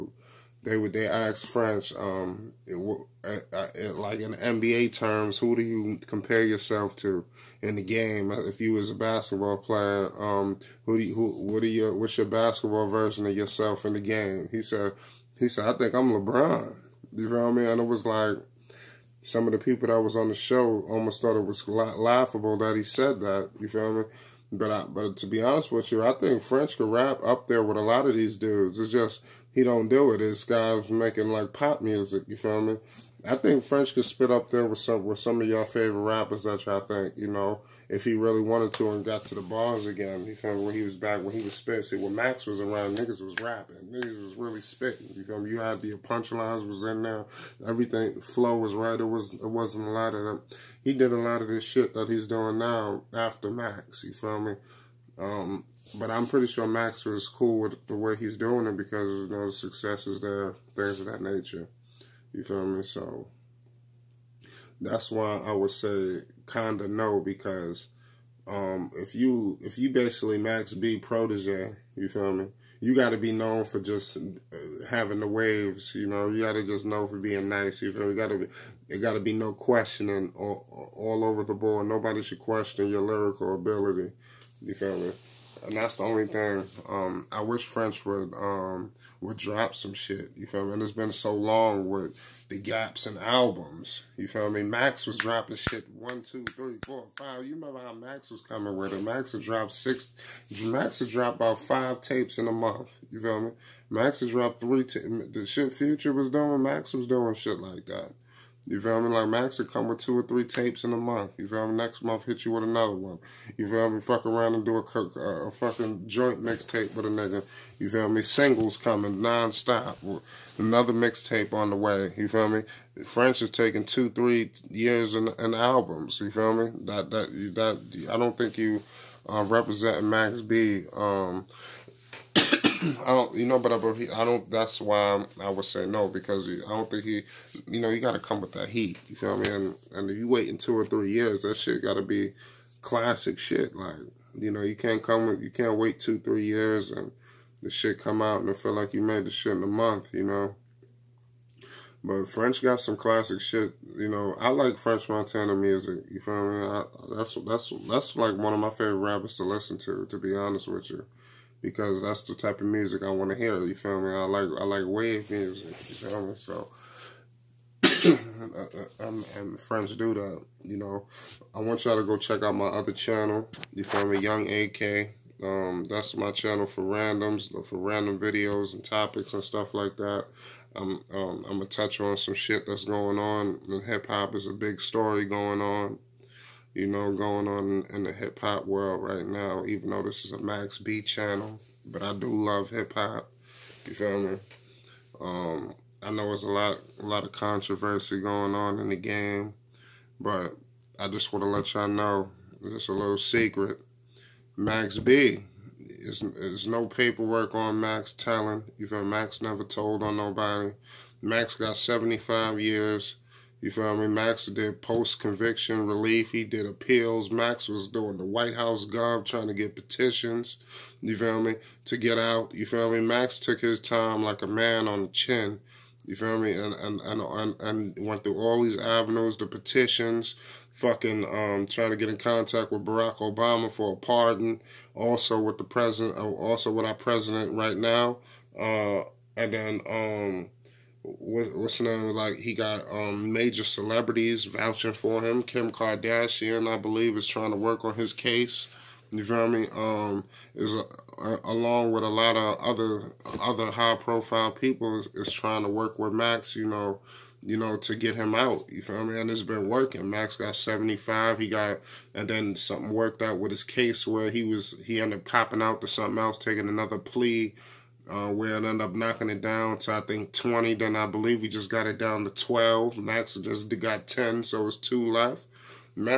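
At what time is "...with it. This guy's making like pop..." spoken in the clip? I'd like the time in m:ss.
0:30.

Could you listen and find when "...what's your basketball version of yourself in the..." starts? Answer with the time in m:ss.
0:11.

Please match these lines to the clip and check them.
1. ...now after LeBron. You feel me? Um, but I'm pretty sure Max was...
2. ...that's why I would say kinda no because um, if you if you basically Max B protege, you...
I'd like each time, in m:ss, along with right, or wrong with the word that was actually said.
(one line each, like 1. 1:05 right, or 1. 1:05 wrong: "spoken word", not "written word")
1. 0:52 wrong: "Max", not "LeBron"
2. 1:04 right.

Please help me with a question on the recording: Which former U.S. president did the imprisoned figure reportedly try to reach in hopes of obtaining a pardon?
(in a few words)
Barack Obama.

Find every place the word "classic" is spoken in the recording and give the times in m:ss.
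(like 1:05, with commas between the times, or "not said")
2:22, 2:32.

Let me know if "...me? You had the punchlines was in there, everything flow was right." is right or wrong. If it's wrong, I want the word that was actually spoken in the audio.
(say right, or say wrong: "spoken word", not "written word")
right.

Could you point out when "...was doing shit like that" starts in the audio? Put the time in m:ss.
1:46.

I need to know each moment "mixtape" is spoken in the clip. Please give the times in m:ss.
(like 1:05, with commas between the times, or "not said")
1:56, 2:00.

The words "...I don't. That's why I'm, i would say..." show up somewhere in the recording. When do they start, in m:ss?
2:14.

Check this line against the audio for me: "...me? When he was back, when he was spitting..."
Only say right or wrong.
right.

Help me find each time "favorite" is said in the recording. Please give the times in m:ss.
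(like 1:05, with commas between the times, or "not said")
0:35, 2:38.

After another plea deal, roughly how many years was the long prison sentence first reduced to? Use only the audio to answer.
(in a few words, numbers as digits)
20.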